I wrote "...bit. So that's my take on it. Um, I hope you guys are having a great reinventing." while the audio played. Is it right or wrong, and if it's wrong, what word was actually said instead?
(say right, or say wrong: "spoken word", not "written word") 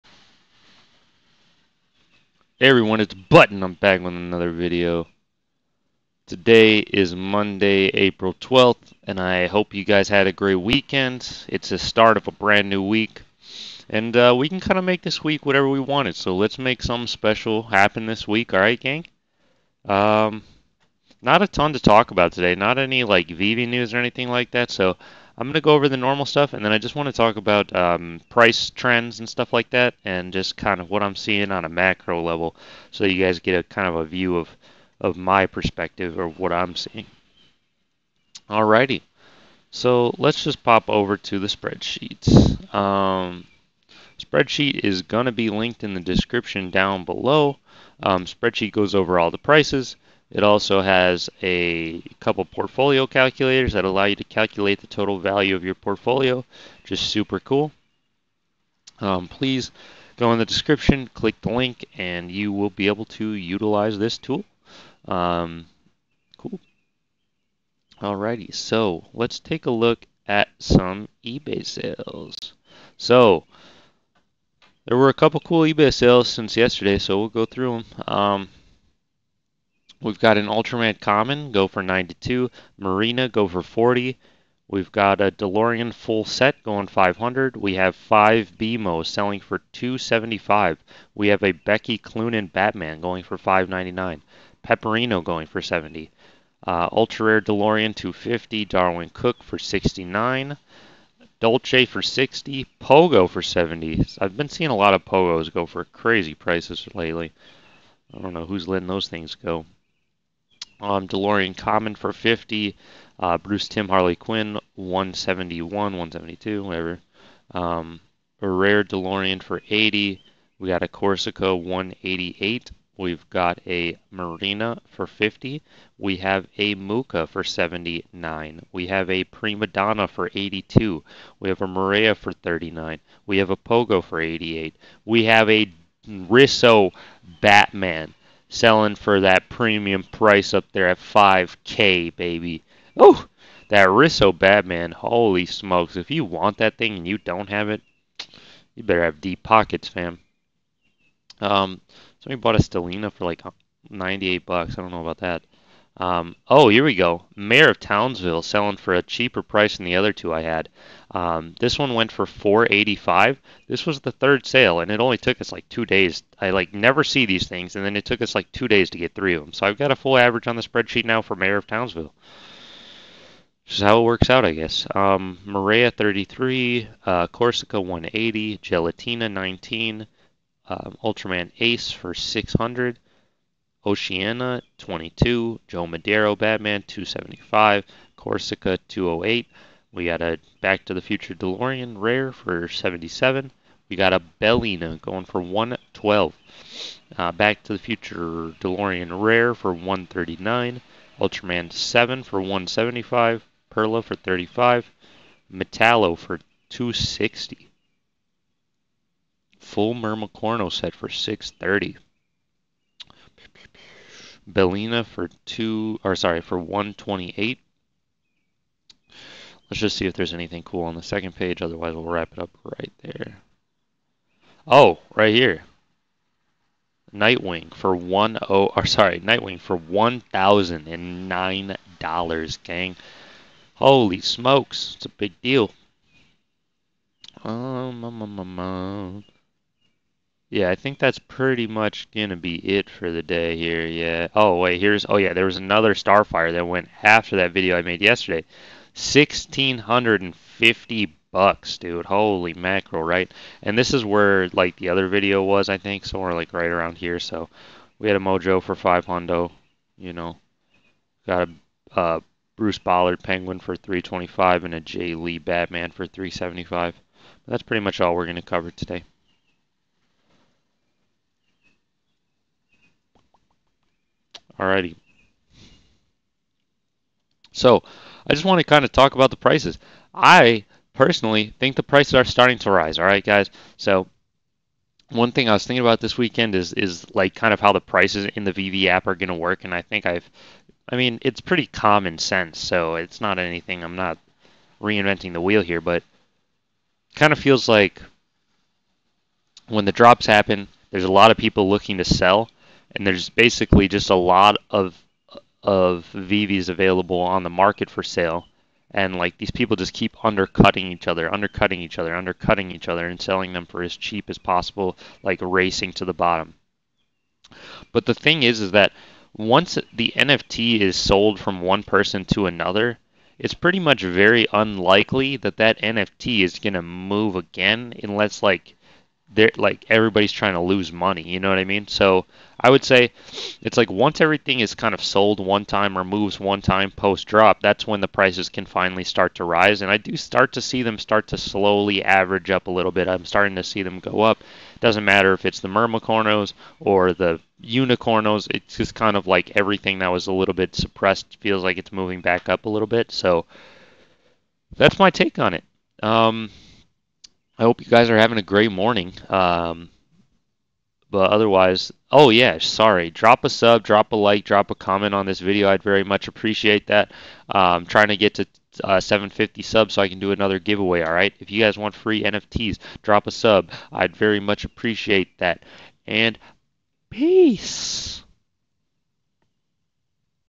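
wrong: "morning", not "reinventing".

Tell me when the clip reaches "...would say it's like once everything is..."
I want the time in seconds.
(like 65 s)
332 s.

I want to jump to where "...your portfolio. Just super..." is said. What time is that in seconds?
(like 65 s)
55 s.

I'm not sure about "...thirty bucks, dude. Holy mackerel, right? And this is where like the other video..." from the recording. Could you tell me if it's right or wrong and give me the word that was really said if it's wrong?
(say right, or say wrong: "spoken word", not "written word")
wrong: "fifty", not "thirty".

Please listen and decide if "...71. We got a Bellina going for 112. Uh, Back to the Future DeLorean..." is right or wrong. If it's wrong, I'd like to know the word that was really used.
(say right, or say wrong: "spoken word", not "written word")
wrong: "77", not "71".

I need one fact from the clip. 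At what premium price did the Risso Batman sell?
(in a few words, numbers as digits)
5K.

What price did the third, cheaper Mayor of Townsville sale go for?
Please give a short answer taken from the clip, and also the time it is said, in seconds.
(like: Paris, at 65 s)
485, at 162 s.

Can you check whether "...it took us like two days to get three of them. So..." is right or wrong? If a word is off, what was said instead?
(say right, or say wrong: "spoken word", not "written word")
right.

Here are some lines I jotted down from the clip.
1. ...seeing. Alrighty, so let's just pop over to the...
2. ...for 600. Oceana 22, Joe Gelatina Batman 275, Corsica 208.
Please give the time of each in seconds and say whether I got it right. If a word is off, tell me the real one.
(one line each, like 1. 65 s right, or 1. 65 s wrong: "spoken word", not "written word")
1. 36 s right
2. 181 s wrong: "Madero", not "Gelatina".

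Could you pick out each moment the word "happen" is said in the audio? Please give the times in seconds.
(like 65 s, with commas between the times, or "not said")
17 s, 300 s.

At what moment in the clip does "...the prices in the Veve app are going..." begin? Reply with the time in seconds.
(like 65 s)
287 s.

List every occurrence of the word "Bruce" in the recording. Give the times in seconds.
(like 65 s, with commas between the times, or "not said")
113 s, 262 s.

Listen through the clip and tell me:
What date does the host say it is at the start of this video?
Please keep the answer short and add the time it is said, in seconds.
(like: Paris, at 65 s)
Monday, April 12th, at 7 s.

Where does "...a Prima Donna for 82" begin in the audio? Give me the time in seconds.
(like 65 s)
129 s.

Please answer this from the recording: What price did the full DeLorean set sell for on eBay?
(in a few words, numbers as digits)
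500.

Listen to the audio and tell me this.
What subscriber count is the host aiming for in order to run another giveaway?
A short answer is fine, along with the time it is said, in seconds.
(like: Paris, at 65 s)
750, at 369 s.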